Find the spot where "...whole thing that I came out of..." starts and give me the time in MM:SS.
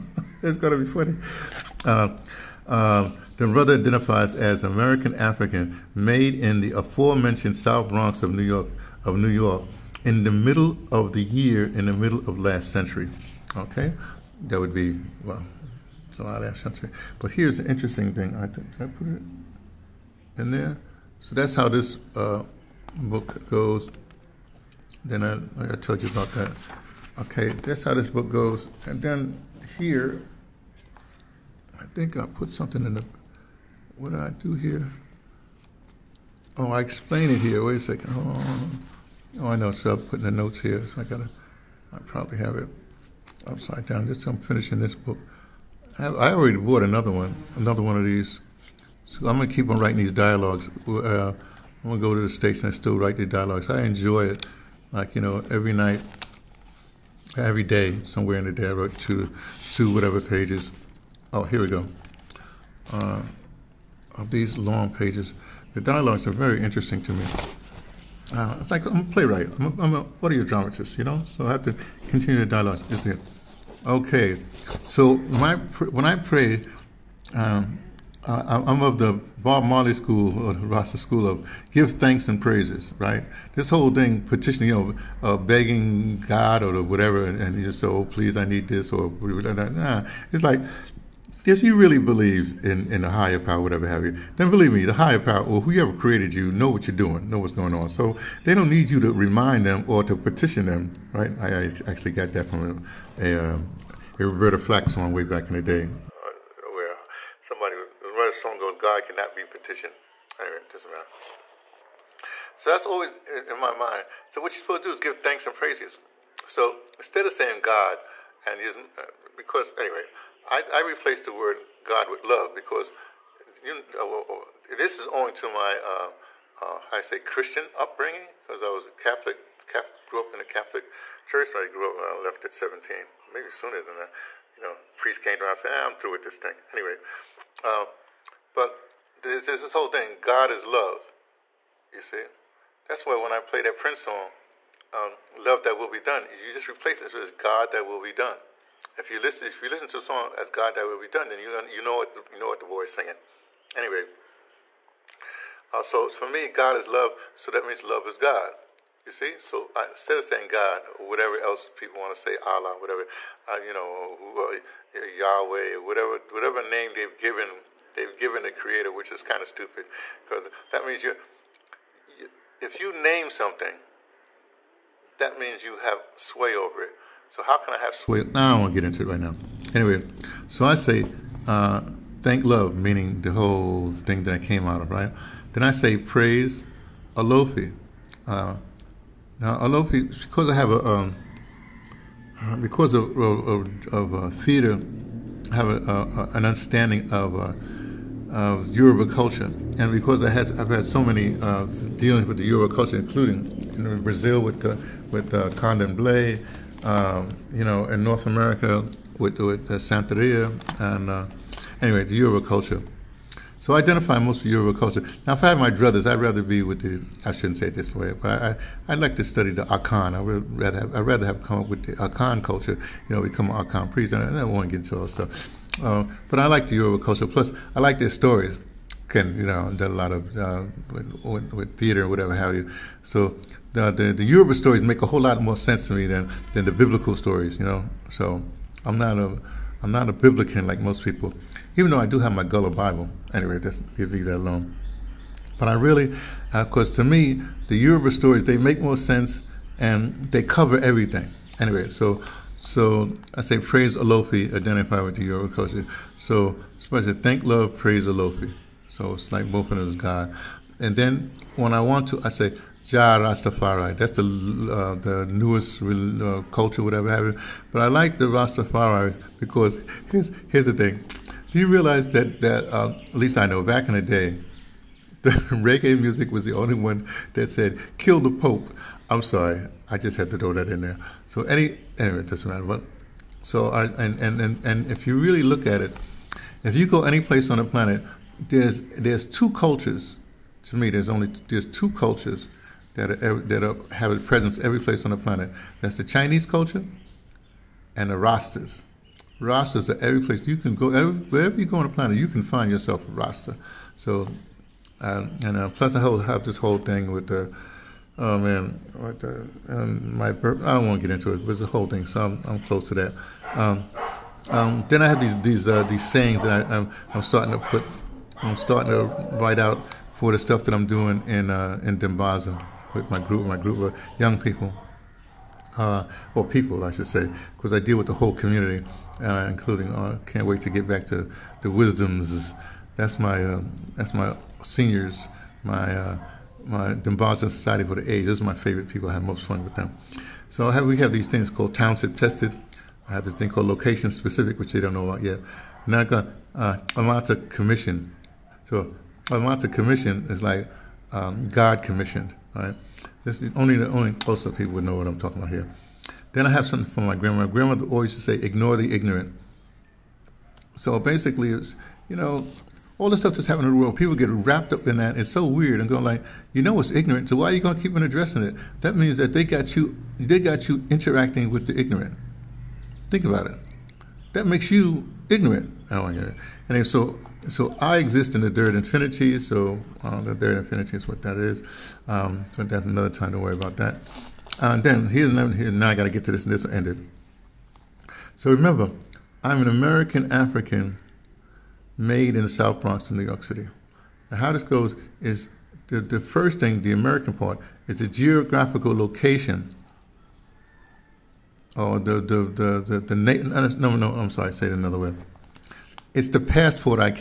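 03:03.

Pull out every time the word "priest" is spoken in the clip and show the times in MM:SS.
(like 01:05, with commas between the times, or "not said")
02:14, 03:43.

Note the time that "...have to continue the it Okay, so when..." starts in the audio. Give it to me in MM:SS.
01:11.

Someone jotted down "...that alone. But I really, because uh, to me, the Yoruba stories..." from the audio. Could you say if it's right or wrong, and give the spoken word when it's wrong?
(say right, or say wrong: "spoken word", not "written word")
right.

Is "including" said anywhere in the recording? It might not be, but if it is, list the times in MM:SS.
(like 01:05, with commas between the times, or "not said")
03:22, 05:29.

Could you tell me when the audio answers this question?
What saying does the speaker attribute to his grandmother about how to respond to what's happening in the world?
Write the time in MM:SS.
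05:58.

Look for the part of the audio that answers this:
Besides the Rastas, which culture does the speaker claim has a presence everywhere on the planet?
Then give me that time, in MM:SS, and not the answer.
04:56.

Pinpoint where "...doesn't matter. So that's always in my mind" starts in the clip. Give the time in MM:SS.
01:50.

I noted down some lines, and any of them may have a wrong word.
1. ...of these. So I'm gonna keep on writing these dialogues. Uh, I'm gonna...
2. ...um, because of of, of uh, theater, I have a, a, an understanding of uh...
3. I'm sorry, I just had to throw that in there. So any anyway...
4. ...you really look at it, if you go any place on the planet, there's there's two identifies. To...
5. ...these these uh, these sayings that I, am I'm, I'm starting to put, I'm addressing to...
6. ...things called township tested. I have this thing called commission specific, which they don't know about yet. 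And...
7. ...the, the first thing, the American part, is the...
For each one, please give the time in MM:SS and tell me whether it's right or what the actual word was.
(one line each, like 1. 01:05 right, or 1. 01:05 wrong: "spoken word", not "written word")
1. 00:47 right
2. 03:10 right
3. 04:39 right
4. 04:45 wrong: "cultures", not "identifies"
5. 05:15 wrong: "starting", not "addressing"
6. 05:41 wrong: "location", not "commission"
7. 06:35 right.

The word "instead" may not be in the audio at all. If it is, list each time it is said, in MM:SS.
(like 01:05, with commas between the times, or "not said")
01:56, 02:39.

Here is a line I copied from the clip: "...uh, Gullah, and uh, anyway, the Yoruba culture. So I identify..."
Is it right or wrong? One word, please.
wrong.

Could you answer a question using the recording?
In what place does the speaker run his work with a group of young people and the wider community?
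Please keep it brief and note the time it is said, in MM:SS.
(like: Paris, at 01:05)
Dimbaza, at 05:21.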